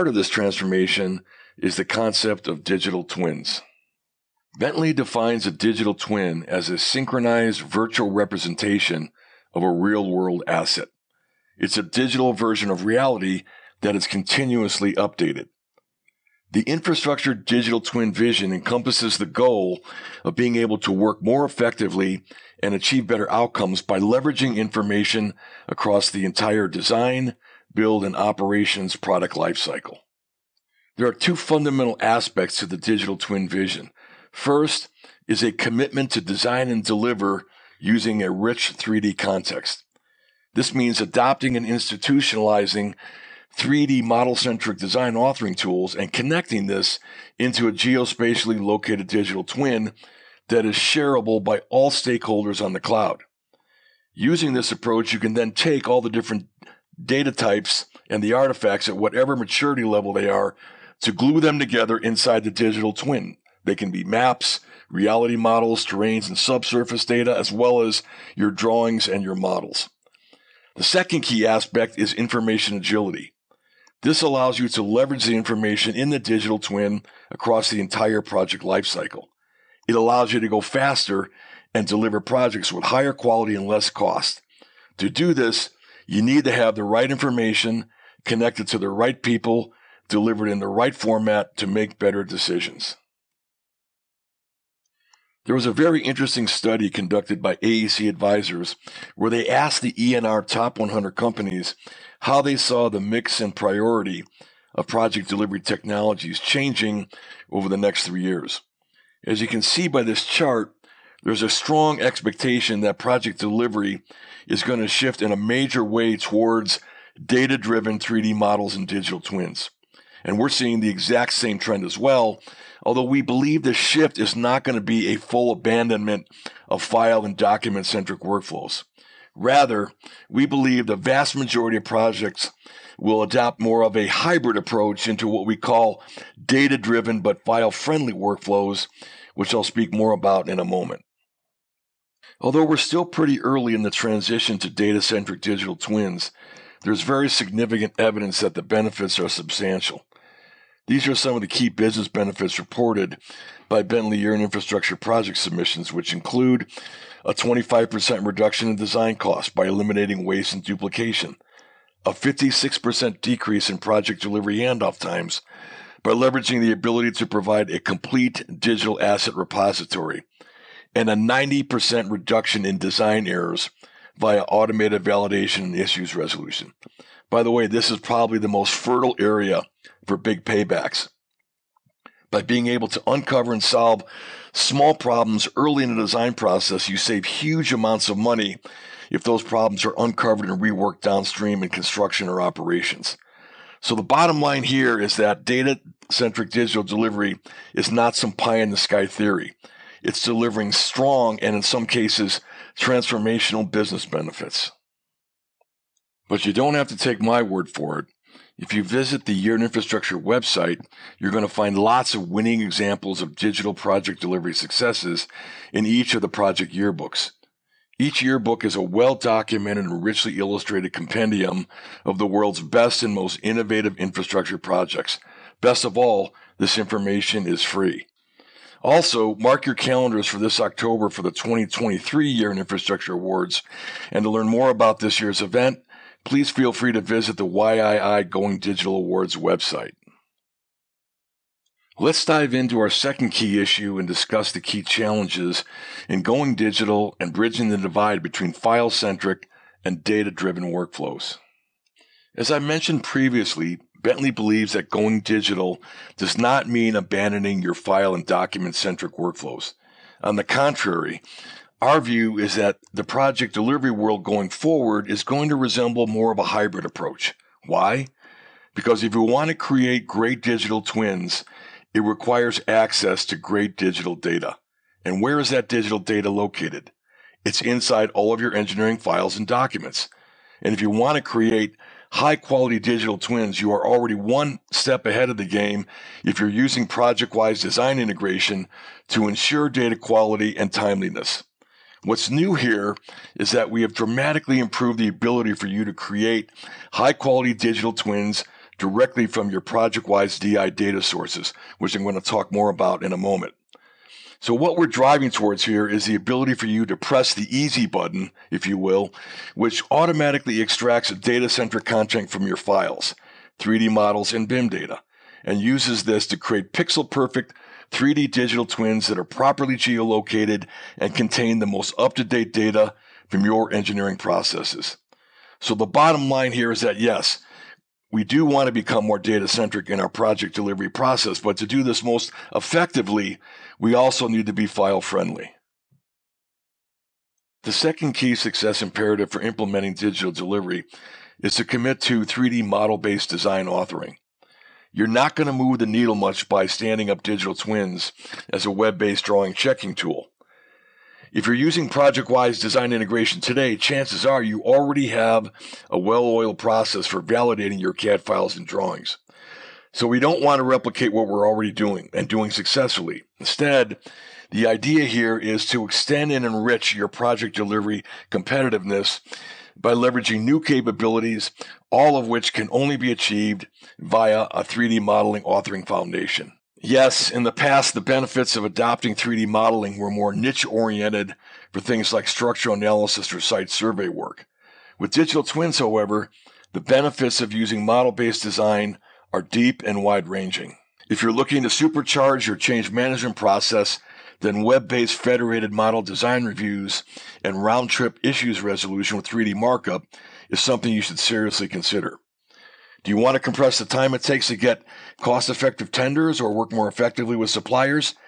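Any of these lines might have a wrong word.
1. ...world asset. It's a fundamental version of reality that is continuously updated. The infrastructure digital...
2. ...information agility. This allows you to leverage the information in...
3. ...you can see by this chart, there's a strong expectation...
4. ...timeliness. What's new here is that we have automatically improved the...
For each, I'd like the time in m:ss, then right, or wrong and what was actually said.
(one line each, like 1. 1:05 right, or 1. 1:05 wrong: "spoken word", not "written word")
1. 0:10 wrong: "digital", not "fundamental"
2. 1:12 right
3. 1:49 right
4. 4:50 wrong: "dramatically", not "automatically".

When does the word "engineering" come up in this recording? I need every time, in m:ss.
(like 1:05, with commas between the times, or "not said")
4:38, 5:23.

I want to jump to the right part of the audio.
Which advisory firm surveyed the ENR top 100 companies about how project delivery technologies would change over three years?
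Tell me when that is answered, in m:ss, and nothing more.
1:37.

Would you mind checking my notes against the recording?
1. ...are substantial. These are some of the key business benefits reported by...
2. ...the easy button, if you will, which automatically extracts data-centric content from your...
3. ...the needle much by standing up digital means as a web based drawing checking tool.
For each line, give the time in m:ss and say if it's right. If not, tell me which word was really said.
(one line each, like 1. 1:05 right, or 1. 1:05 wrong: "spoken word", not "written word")
1. 2:29 right
2. 5:07 right
3. 5:45 wrong: "twins", not "means".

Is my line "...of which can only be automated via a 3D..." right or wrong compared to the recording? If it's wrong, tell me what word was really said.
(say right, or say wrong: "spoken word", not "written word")
wrong: "achieved", not "automated".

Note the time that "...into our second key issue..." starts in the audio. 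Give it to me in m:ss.
4:02.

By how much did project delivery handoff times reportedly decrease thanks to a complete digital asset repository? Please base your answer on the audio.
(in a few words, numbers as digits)
56%.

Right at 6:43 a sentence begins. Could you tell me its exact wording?
Do you want to compress the time it takes to get cost effective tenders or work more effectively with suppliers?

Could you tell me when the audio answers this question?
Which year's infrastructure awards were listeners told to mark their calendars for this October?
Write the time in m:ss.
3:51.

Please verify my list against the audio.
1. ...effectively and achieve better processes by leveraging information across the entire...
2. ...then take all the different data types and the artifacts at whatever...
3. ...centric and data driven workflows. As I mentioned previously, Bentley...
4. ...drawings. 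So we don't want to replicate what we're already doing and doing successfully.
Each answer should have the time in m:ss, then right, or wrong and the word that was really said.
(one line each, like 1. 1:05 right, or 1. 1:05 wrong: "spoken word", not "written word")
1. 0:21 wrong: "outcomes", not "processes"
2. 0:55 right
3. 4:08 right
4. 5:58 right.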